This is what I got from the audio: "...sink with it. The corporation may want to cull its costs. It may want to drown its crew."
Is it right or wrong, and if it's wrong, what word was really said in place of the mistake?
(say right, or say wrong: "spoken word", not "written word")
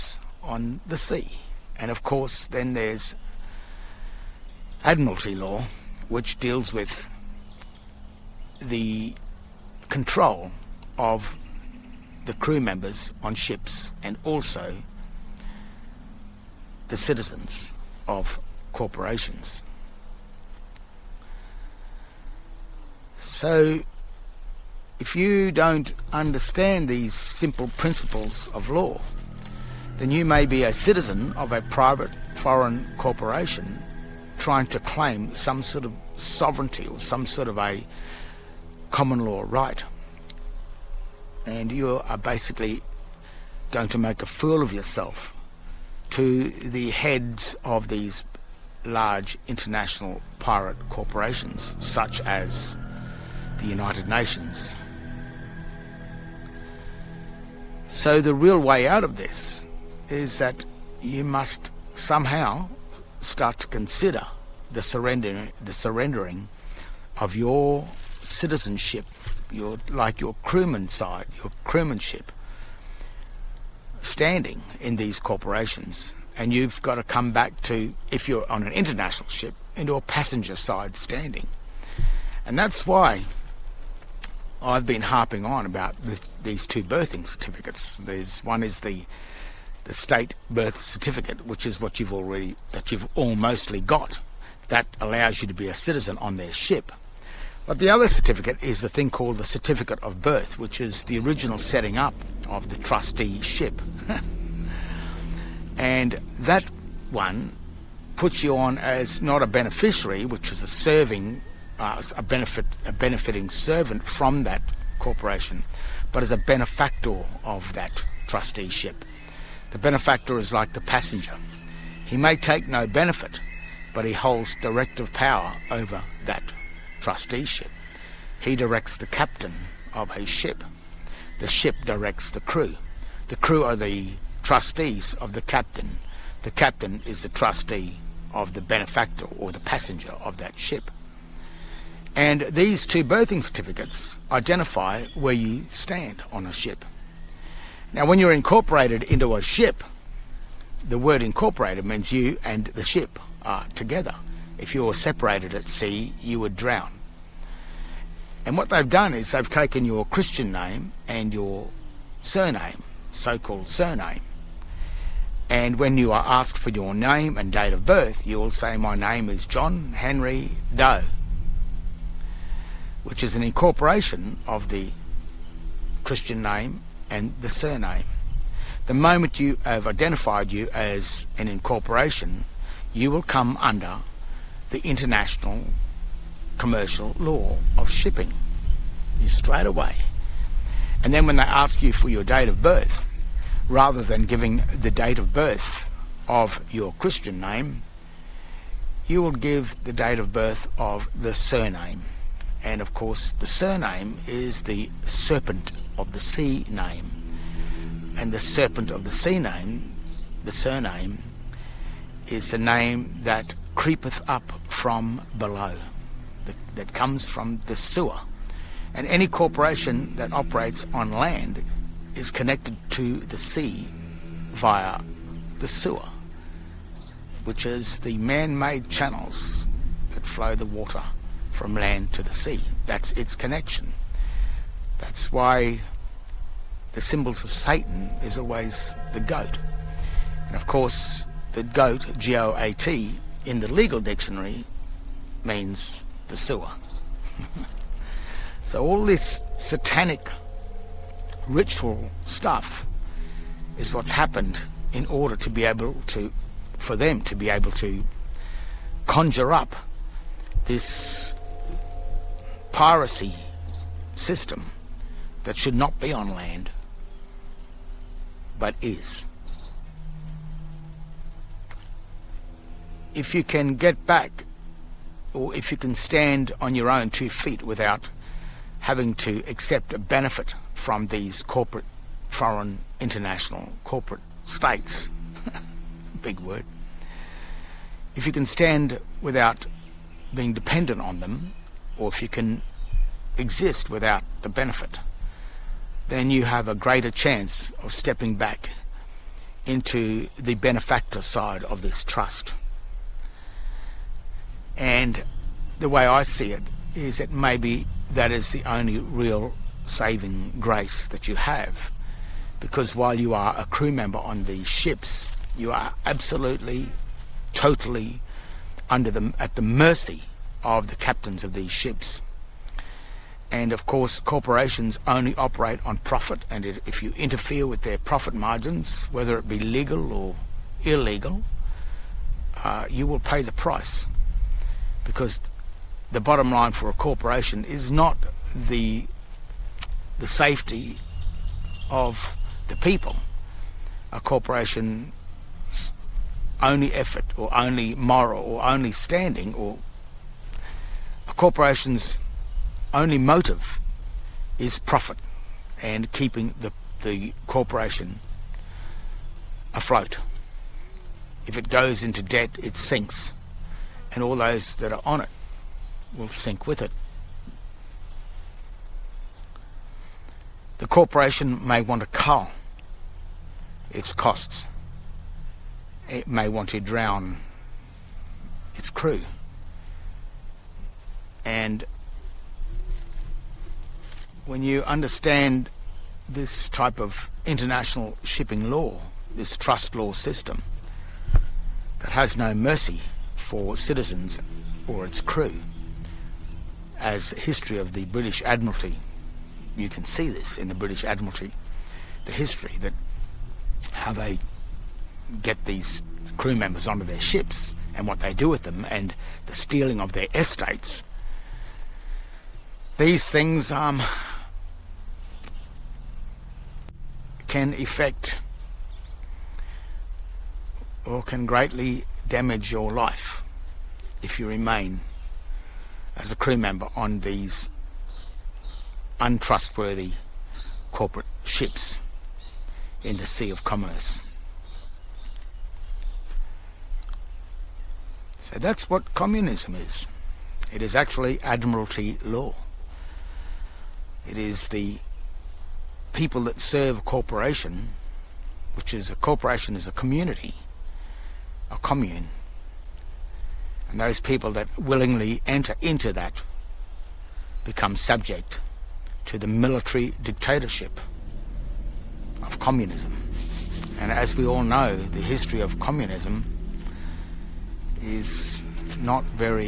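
right.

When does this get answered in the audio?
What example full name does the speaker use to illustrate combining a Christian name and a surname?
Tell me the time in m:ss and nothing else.
2:49.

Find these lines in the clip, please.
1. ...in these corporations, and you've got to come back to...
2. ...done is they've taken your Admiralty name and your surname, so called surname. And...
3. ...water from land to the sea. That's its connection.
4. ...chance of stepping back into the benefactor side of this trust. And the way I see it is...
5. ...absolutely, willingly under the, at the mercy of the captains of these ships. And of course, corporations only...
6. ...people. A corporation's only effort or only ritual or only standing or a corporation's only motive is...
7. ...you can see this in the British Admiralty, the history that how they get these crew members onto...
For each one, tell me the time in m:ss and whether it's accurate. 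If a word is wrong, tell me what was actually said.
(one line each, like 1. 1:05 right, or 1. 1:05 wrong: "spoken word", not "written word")
1. 1:14 right
2. 2:38 wrong: "Christian", not "Admiralty"
3. 3:50 right
4. 4:57 right
5. 5:16 wrong: "totally", not "willingly"
6. 5:42 wrong: "moral", not "ritual"
7. 6:39 right.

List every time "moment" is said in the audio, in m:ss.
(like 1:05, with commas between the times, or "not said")
2:58.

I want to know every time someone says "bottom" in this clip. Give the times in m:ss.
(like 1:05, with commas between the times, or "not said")
5:36.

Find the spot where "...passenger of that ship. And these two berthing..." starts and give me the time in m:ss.
2:19.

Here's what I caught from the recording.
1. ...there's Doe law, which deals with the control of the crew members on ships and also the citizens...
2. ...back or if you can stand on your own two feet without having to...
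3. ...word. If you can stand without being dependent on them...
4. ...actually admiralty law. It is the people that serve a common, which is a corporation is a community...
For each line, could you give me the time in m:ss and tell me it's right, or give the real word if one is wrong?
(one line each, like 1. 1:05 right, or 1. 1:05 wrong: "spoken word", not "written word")
1. 0:02 wrong: "Admiralty", not "Doe"
2. 4:34 right
3. 4:46 right
4. 7:20 wrong: "corporation", not "common".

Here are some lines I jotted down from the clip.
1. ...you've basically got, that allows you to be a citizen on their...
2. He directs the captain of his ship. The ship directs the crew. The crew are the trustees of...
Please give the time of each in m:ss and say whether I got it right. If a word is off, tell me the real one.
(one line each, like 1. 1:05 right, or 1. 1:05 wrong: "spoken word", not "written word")
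1. 1:32 wrong: "almostly", not "basically"
2. 2:08 right.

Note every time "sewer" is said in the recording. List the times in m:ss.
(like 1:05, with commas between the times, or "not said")
3:37, 3:45, 4:06.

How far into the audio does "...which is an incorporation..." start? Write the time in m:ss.
2:53.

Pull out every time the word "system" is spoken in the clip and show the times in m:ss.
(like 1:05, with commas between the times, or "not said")
4:24, 6:30.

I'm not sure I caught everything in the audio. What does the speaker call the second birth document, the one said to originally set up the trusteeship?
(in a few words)
Certificate of Birth.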